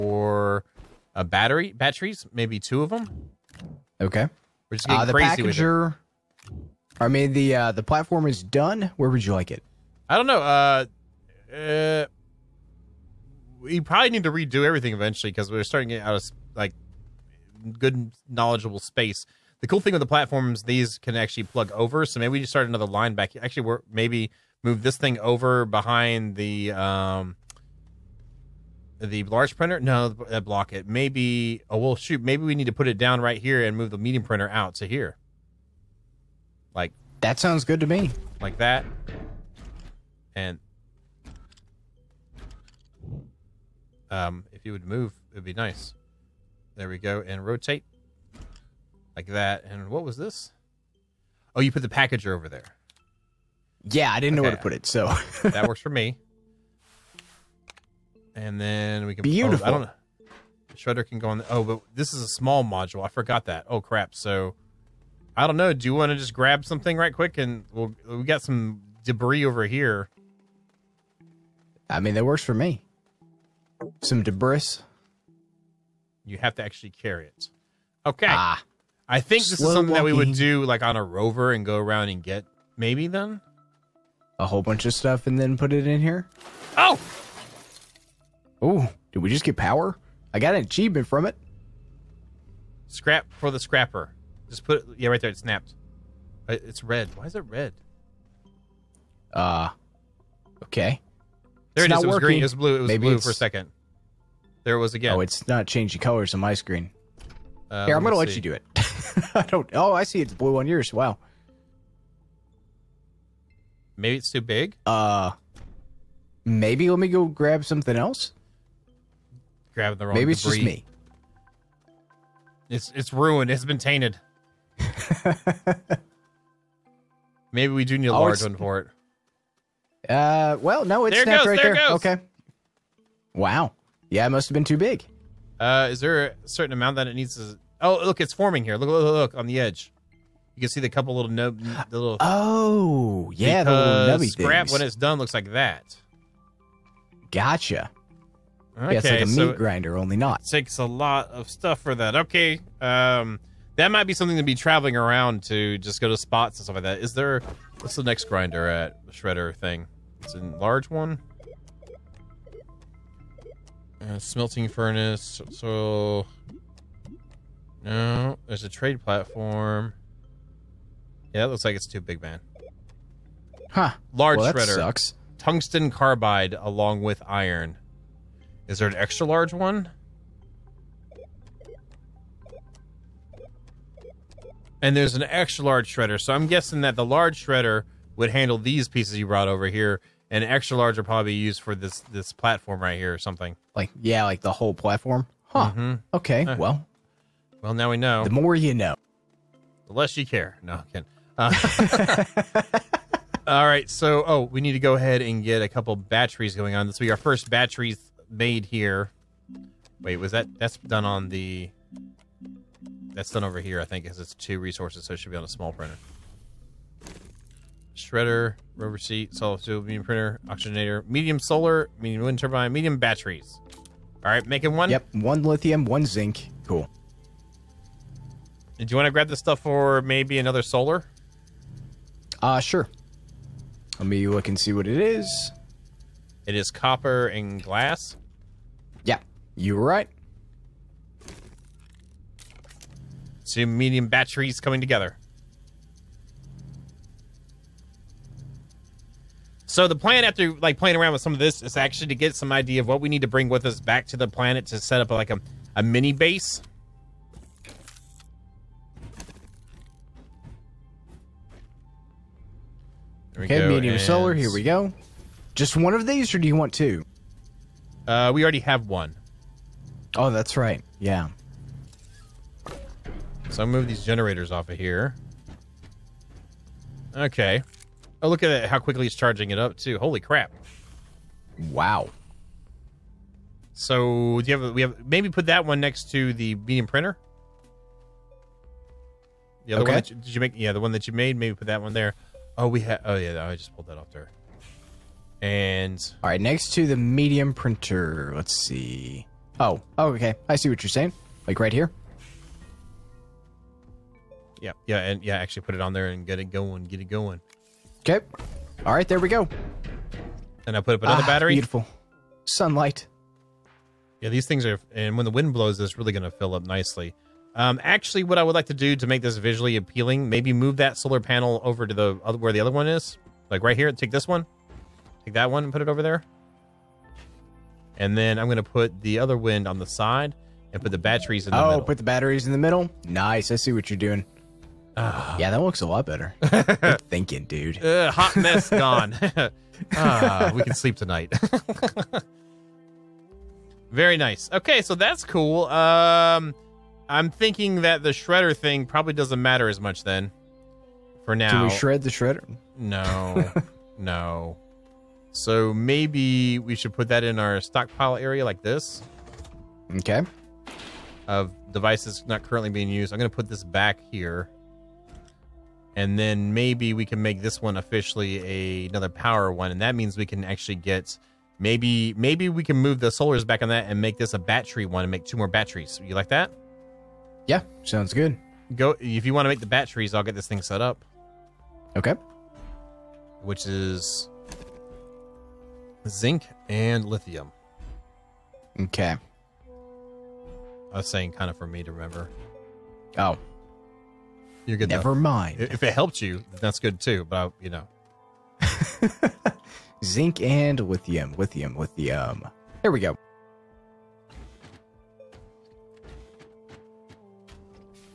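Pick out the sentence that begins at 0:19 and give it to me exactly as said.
The cool thing with the platforms, these can actually plug over.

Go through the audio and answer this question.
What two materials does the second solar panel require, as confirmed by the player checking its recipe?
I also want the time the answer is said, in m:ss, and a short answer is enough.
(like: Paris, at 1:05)
copper and glass, at 3:56.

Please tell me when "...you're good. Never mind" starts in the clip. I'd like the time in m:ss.
6:34.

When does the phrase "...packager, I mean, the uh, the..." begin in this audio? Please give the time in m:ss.
0:05.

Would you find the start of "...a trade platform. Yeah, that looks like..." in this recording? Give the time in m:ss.
2:48.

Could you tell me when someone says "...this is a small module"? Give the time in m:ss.
1:01.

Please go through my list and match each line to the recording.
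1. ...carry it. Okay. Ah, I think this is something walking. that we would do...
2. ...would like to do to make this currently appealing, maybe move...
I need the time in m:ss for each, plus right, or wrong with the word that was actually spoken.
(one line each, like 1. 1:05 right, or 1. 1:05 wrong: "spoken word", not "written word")
1. 1:16 right
2. 5:18 wrong: "visually", not "currently".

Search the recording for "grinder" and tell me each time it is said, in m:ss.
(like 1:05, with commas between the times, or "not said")
2:29, 2:38.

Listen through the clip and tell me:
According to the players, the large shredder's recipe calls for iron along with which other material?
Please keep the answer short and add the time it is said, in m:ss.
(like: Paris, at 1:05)
Tungsten carbide, at 2:55.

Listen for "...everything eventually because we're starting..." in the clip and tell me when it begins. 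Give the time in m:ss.
0:14.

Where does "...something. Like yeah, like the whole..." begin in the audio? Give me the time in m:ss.
3:13.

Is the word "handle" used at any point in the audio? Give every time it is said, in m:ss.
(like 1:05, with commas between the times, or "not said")
3:08.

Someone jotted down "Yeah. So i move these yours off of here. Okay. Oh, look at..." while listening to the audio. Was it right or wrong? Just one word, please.
wrong.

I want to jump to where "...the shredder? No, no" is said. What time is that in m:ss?
5:52.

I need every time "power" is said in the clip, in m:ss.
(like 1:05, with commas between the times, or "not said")
1:29, 6:09.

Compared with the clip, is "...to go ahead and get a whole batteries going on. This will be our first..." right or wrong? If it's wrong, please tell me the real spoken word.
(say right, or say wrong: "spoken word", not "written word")
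wrong: "couple", not "whole".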